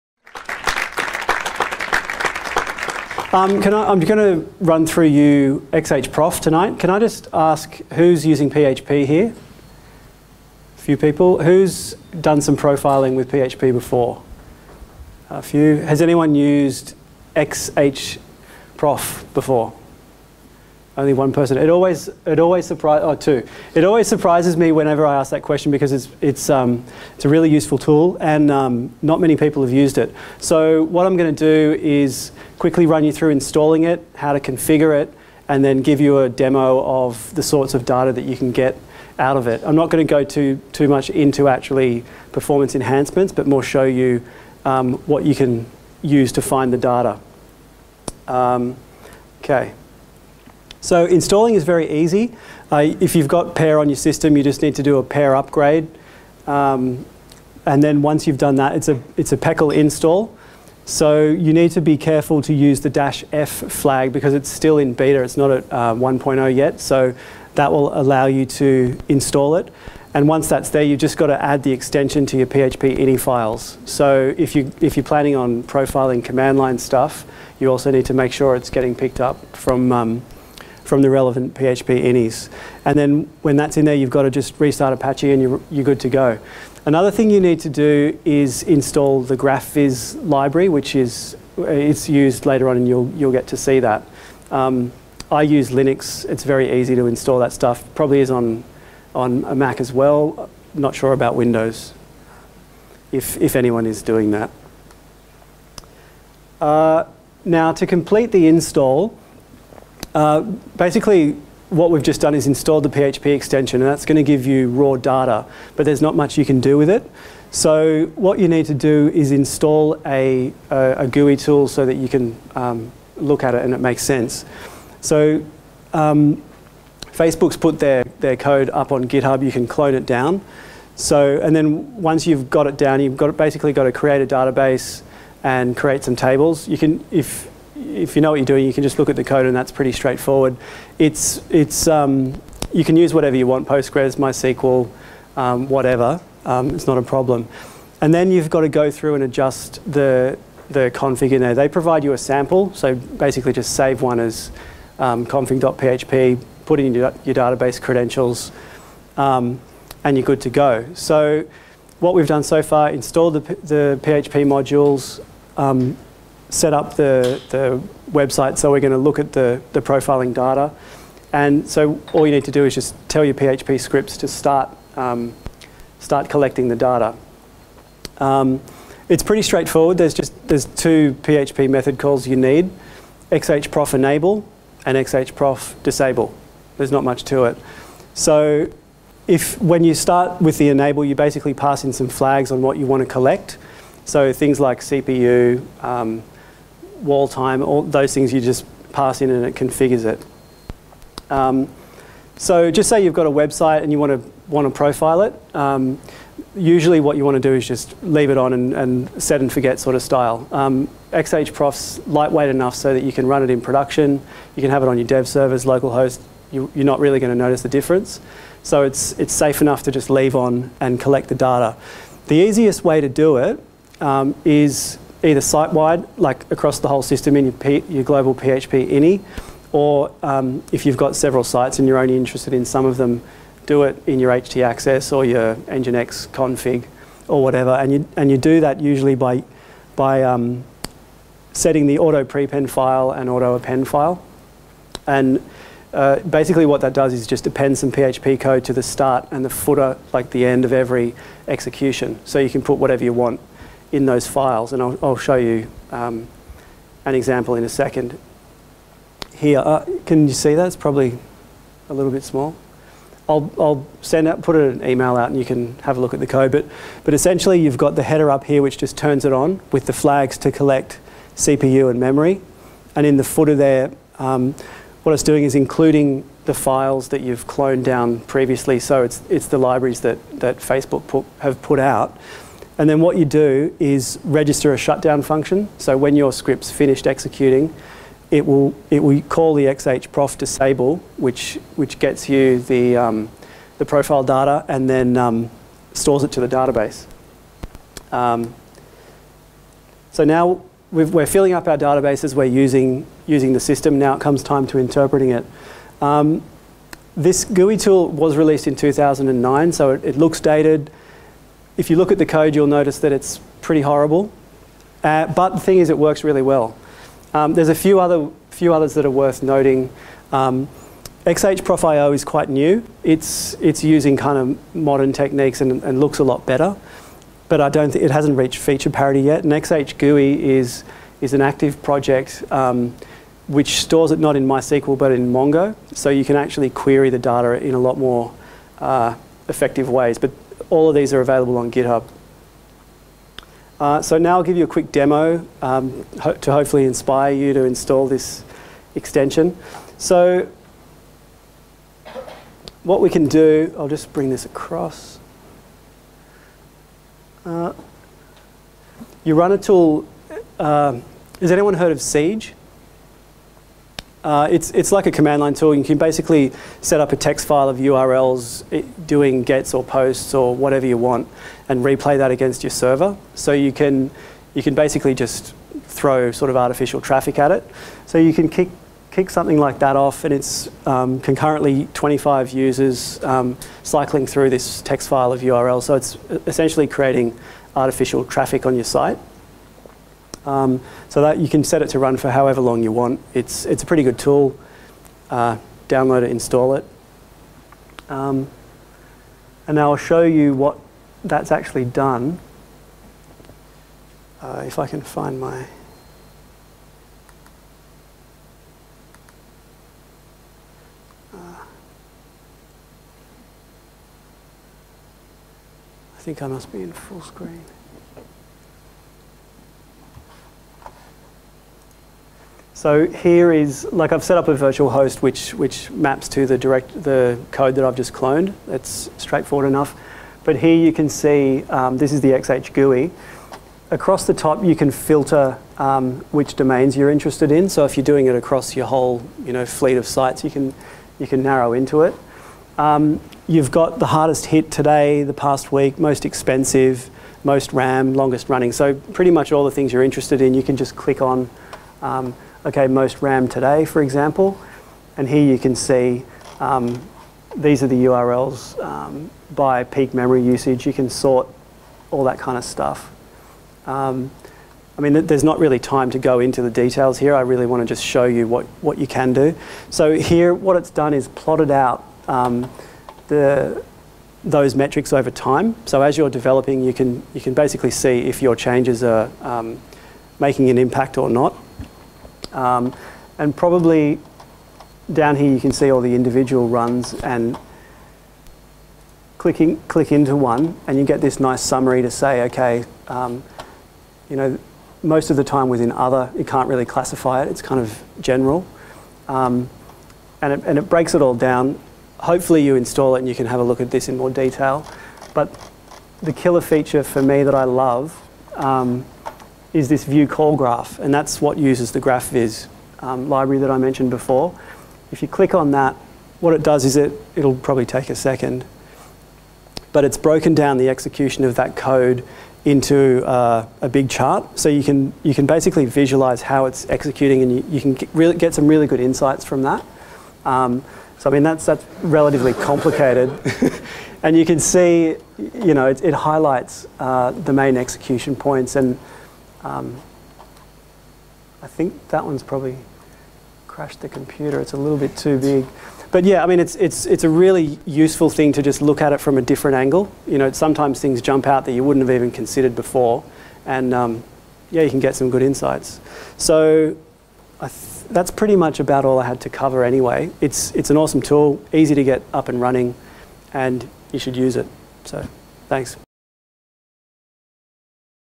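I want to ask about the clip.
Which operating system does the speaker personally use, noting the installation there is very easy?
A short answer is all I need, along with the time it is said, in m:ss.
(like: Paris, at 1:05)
Linux, at 1:35.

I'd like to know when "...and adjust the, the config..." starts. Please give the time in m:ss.
2:29.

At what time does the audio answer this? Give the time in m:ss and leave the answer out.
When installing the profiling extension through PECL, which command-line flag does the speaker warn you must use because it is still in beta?
1:02.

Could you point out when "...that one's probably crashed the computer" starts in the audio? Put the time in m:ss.
9:02.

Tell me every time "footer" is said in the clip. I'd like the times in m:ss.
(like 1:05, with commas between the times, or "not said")
4:09, 4:33.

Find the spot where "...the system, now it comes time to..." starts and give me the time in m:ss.
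5:03.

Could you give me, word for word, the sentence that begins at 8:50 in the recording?
Um, so I mean, that's, that's relatively complicated.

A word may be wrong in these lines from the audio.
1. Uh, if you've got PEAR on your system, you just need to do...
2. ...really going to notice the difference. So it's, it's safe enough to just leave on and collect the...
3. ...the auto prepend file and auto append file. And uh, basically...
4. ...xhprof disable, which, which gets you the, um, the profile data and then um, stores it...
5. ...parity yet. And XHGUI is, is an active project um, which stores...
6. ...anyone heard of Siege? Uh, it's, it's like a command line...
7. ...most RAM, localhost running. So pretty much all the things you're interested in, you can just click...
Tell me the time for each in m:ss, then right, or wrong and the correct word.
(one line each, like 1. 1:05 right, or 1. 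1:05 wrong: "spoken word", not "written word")
1. 0:52 right
2. 3:36 right
3. 4:01 right
4. 4:49 right
5. 5:28 right
6. 6:01 right
7. 7:27 wrong: "longest", not "localhost".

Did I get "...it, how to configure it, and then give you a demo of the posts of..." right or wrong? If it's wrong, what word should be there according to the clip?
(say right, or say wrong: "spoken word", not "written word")
wrong: "sorts", not "posts".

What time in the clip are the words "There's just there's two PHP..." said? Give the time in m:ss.
2:59.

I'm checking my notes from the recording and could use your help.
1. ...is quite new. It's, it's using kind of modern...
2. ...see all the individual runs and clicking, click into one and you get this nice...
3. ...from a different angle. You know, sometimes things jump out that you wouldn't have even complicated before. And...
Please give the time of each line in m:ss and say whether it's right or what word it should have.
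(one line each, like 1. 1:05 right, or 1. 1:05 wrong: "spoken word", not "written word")
1. 5:22 right
2. 8:05 right
3. 9:09 wrong: "considered", not "complicated".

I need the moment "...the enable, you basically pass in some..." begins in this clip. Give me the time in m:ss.
3:10.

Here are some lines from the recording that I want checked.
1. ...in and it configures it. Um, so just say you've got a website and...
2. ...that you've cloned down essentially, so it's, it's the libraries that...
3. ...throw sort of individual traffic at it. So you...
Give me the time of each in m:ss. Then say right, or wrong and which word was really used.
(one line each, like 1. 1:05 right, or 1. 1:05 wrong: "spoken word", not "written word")
1. 3:19 right
2. 4:37 wrong: "previously", not "essentially"
3. 6:15 wrong: "artificial", not "individual".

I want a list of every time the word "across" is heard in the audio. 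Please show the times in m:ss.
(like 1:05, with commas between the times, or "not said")
3:46, 5:54, 7:13, 7:18.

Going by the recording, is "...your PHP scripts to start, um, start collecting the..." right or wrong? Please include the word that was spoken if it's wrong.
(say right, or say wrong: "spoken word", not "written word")
right.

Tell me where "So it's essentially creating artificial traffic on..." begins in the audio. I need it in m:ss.
6:25.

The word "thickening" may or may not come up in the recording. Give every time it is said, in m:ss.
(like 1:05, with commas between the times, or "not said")
not said.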